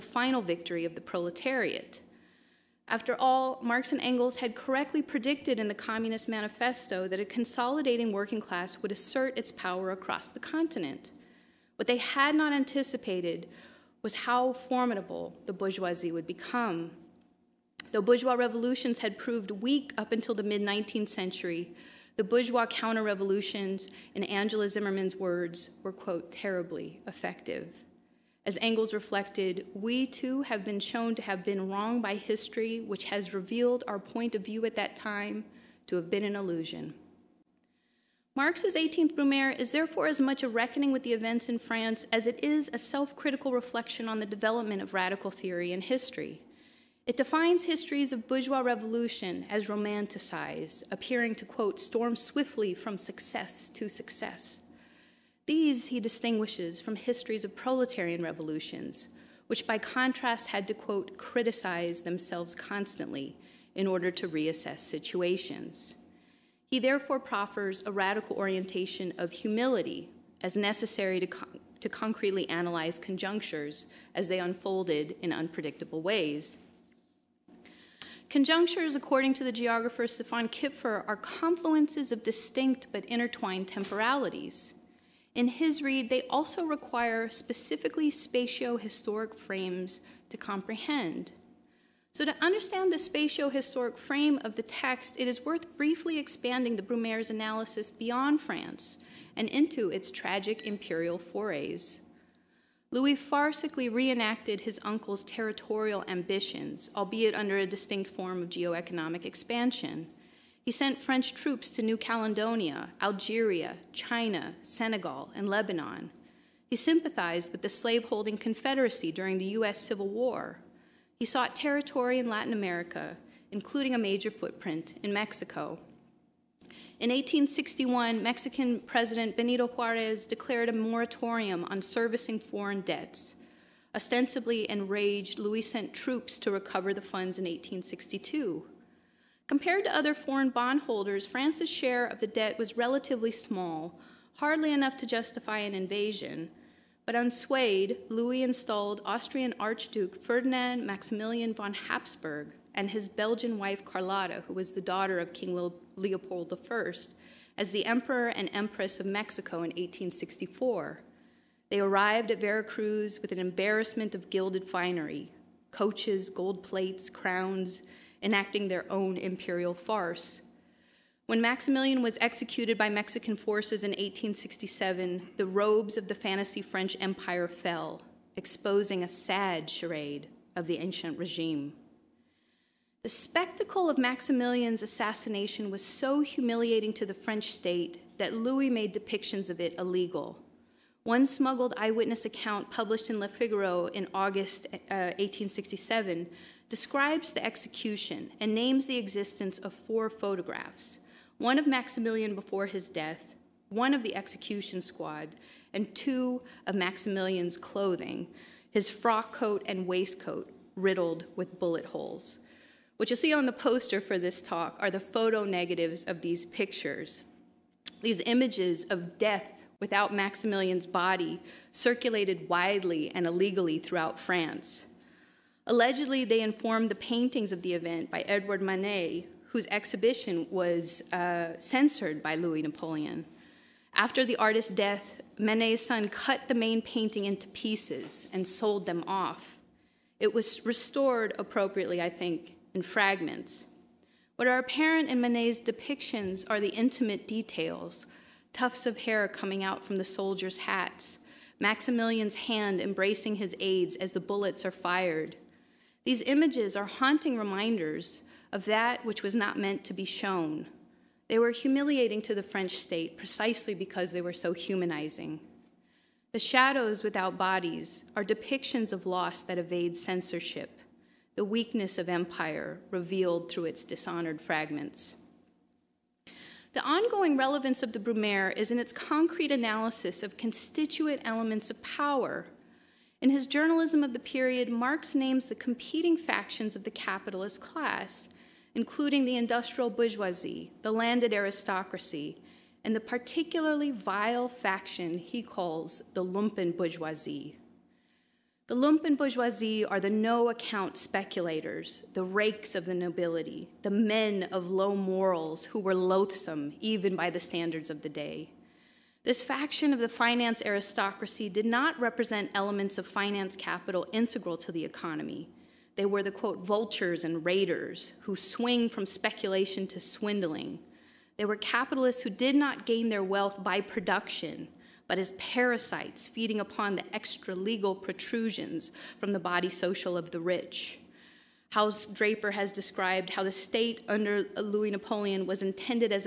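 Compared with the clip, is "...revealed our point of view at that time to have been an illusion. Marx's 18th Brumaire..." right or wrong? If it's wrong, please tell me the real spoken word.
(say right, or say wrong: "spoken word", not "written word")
right.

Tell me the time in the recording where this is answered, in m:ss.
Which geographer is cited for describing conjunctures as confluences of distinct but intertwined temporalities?
1:20.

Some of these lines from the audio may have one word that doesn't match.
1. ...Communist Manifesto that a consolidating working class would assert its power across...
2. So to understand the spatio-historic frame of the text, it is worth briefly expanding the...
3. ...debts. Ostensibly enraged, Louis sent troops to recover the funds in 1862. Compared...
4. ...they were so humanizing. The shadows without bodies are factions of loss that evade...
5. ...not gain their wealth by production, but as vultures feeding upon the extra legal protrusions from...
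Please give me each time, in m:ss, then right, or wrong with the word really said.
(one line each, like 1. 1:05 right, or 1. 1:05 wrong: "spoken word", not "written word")
1. 0:05 right
2. 1:32 right
3. 2:12 right
4. 4:24 wrong: "depictions", not "factions"
5. 5:22 wrong: "parasites", not "vultures".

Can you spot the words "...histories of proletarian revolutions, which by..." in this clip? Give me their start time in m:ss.
0:56.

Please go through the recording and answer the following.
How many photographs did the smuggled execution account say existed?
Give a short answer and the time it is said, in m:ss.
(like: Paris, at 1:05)
4, at 3:19.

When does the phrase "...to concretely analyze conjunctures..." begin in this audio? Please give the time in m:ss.
1:11.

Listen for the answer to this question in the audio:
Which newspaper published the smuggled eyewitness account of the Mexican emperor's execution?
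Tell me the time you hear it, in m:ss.
3:13.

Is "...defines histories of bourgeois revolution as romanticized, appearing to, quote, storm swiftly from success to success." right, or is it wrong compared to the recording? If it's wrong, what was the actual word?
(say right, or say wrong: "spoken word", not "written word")
right.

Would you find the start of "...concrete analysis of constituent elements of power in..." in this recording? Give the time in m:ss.
4:38.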